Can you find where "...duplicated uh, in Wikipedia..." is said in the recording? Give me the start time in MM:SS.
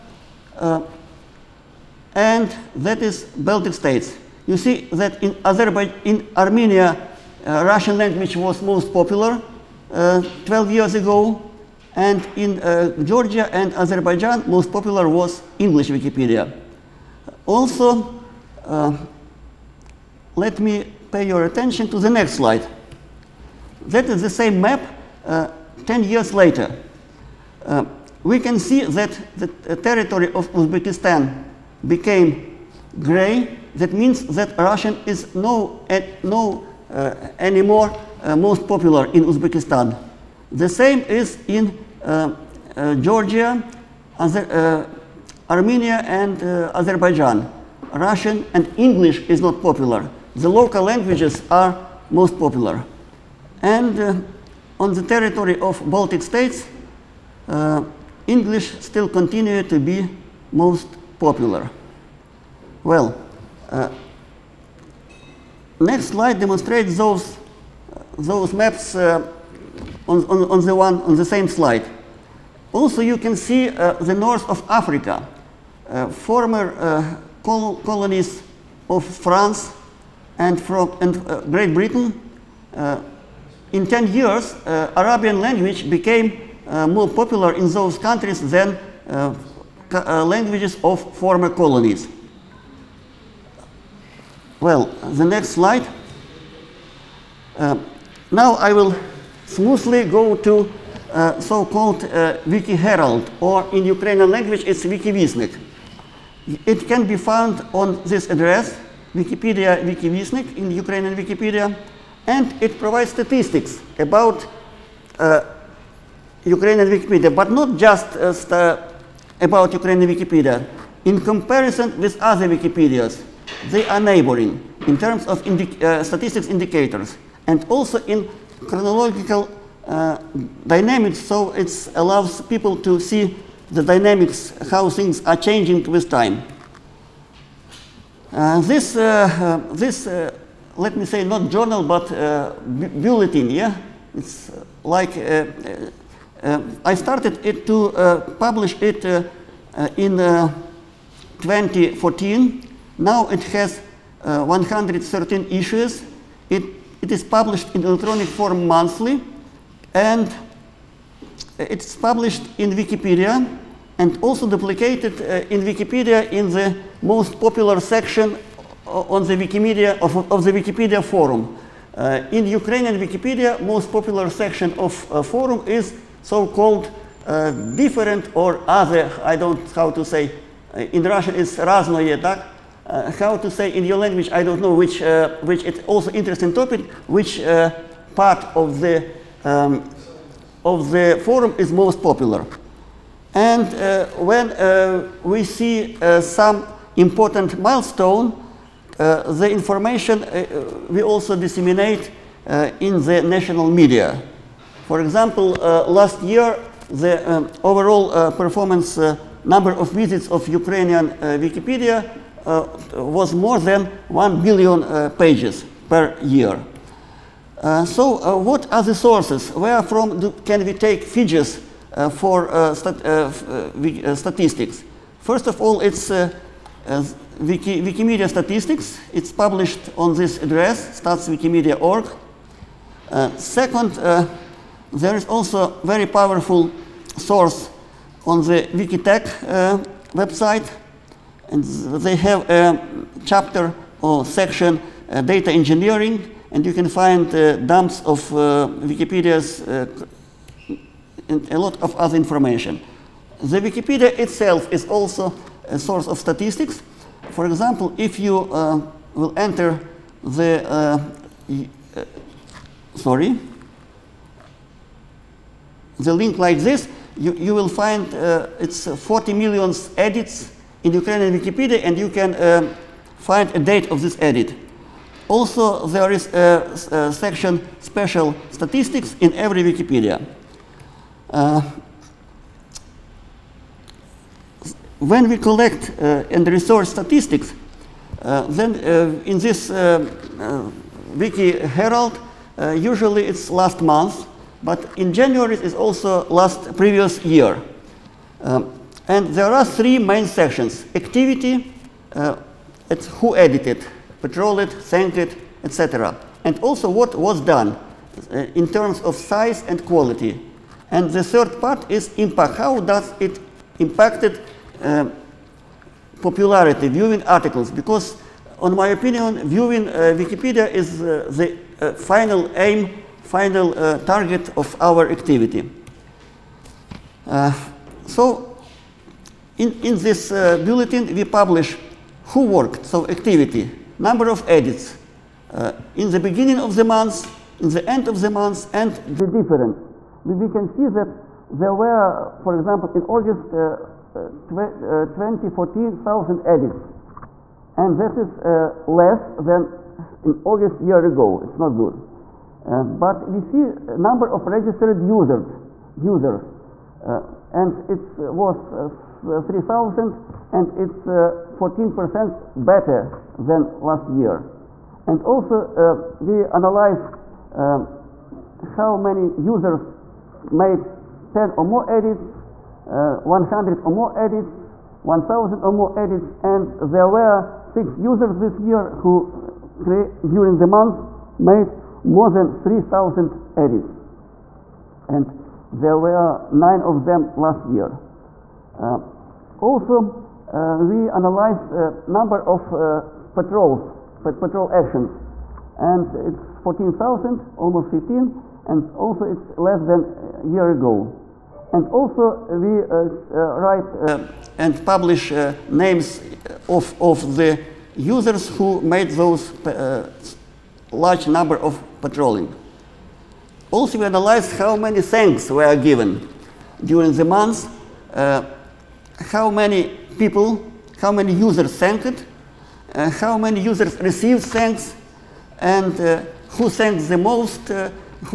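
02:44.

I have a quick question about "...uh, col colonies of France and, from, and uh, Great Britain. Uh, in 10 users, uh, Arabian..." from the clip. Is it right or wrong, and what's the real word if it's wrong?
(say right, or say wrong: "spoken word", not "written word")
wrong: "years", not "users".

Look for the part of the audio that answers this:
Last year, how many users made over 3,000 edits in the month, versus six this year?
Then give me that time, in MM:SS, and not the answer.
06:26.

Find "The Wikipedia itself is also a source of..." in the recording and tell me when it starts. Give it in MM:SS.
04:13.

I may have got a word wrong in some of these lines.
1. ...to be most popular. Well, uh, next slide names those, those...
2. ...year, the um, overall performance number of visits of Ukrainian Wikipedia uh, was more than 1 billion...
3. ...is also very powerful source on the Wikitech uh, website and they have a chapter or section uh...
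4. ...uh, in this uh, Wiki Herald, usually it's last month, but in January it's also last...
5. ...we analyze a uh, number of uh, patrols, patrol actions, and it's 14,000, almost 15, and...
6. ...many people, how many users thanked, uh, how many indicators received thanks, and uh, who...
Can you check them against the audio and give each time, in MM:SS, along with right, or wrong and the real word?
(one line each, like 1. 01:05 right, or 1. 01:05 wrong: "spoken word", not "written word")
1. 00:59 wrong: "demonstrates", not "names"
2. 03:26 right
3. 03:55 right
4. 04:48 right
5. 06:30 right
6. 06:59 wrong: "users", not "indicators".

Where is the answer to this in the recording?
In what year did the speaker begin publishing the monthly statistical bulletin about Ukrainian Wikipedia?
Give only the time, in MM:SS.
02:30.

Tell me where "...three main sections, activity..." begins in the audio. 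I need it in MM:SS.
04:59.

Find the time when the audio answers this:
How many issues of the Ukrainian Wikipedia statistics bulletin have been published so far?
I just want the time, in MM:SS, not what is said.
02:34.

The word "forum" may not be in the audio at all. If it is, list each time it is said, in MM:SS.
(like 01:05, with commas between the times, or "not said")
02:51, 02:55, 03:11.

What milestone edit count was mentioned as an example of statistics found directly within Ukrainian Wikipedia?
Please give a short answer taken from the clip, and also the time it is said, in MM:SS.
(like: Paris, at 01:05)
40 million, at 04:28.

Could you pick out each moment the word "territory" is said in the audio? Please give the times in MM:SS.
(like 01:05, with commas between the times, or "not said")
00:29, 00:55.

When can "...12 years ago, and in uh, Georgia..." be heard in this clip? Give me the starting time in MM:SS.
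00:09.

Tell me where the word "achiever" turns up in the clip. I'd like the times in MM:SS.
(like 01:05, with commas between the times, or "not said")
not said.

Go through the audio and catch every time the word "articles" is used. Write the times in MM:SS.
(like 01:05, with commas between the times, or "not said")
05:17.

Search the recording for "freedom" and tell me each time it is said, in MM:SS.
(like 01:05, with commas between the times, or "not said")
not said.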